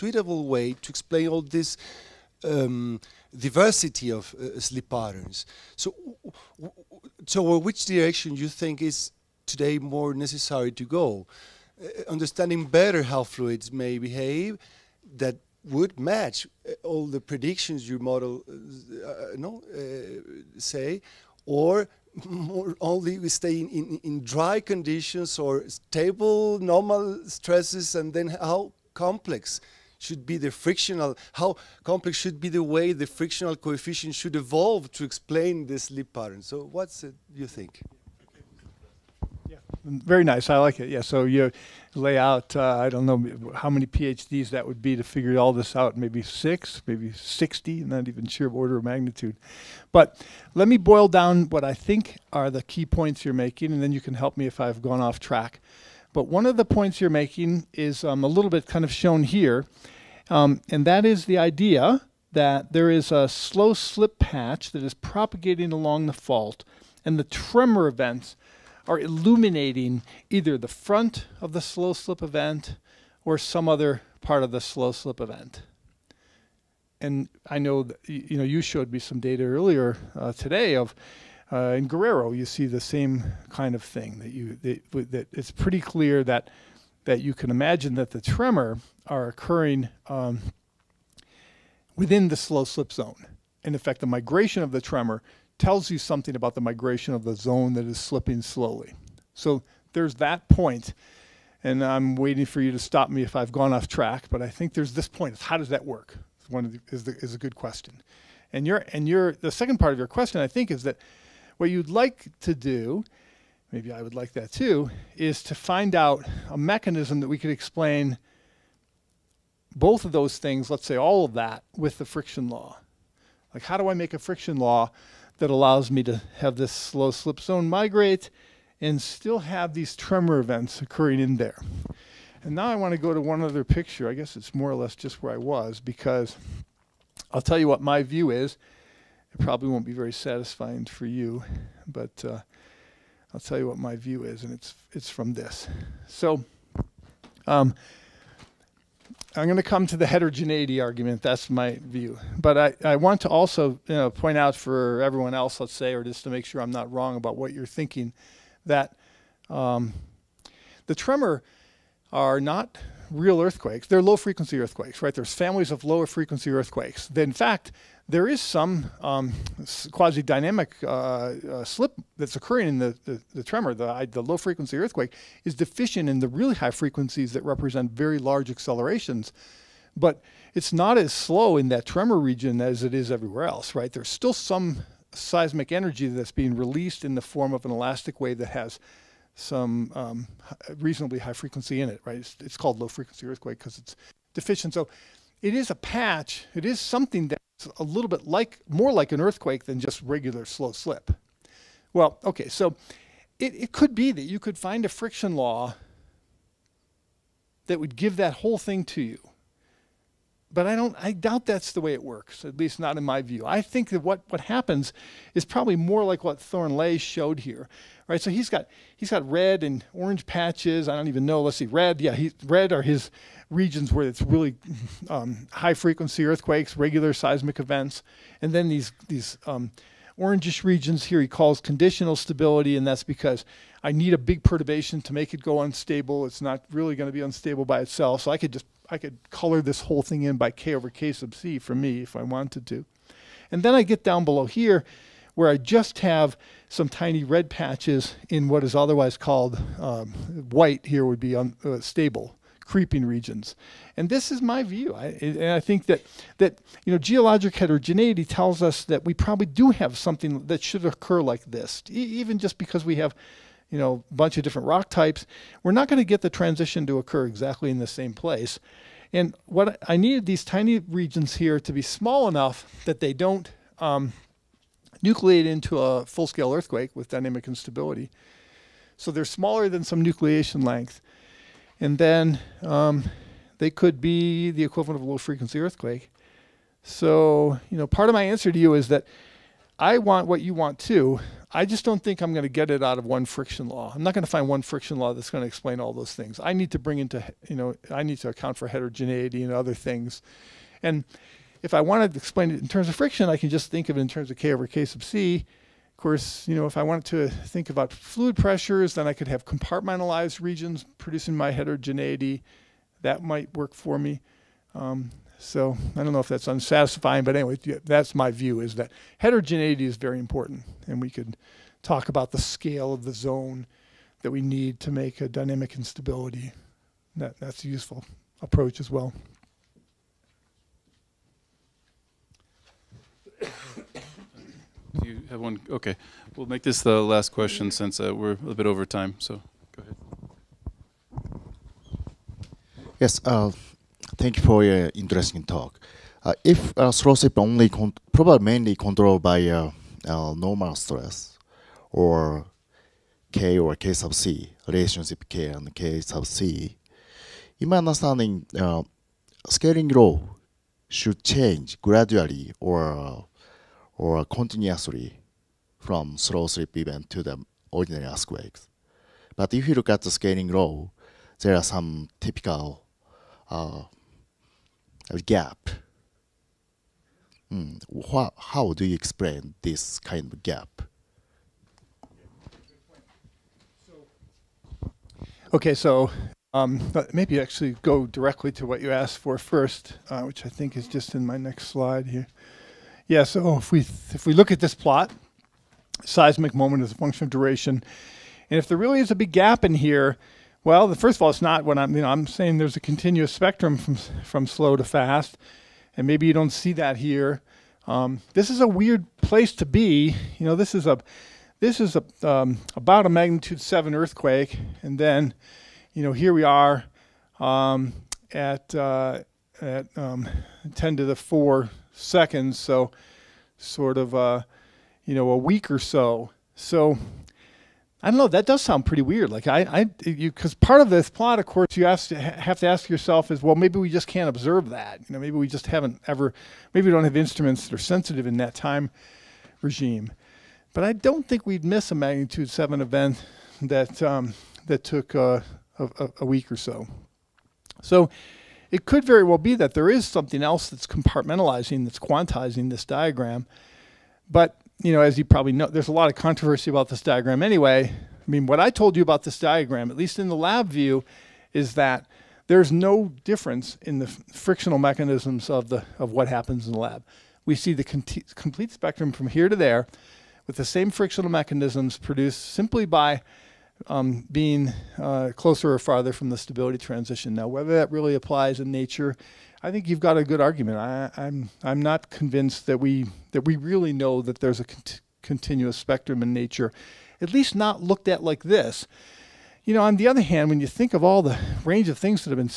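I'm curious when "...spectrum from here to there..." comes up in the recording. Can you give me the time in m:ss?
7:48.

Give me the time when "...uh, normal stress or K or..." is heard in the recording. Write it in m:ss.
5:49.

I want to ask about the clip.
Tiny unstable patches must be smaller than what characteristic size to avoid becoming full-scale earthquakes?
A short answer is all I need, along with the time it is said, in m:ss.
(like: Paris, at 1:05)
nucleation length, at 4:40.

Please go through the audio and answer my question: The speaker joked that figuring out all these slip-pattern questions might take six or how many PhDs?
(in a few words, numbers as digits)
60.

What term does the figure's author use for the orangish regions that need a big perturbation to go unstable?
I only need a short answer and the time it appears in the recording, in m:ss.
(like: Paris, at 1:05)
conditional stability, at 3:51.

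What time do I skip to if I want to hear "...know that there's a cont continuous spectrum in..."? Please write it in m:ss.
8:03.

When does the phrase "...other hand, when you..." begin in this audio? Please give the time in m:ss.
8:10.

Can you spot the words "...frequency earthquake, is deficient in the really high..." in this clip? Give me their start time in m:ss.
2:54.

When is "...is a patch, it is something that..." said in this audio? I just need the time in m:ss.
3:15.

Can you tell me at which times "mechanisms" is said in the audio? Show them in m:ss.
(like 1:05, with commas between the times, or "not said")
1:56, 7:44, 7:51.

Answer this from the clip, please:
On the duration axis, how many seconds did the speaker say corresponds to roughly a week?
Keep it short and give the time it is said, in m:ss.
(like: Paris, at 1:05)
10^4, at 7:00.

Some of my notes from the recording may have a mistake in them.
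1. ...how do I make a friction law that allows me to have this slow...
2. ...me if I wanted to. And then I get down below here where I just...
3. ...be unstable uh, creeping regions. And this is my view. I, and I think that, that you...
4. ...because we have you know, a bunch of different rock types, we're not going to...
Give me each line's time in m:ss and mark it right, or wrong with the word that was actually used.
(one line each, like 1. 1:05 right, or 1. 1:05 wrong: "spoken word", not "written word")
1. 2:03 right
2. 4:01 right
3. 4:11 right
4. 4:22 right.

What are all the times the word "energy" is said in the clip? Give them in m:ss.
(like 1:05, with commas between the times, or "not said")
3:05.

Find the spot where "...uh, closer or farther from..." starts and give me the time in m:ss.
7:54.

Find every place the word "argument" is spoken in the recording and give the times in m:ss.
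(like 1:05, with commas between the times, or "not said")
2:30, 8:00.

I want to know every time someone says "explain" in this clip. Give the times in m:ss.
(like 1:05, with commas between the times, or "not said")
0:00, 0:35, 1:57, 4:55, 5:02, 6:18.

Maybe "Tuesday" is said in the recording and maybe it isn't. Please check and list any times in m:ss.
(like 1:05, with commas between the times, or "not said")
not said.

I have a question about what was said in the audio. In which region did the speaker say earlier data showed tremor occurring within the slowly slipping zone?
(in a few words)
Guerrero.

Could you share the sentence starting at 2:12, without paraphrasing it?
And now I want to go to one other picture.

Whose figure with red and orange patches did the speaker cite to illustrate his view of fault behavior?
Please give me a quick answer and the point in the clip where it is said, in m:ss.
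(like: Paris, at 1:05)
Thornley, at 3:36.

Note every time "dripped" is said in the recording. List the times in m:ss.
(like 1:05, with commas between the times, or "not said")
not said.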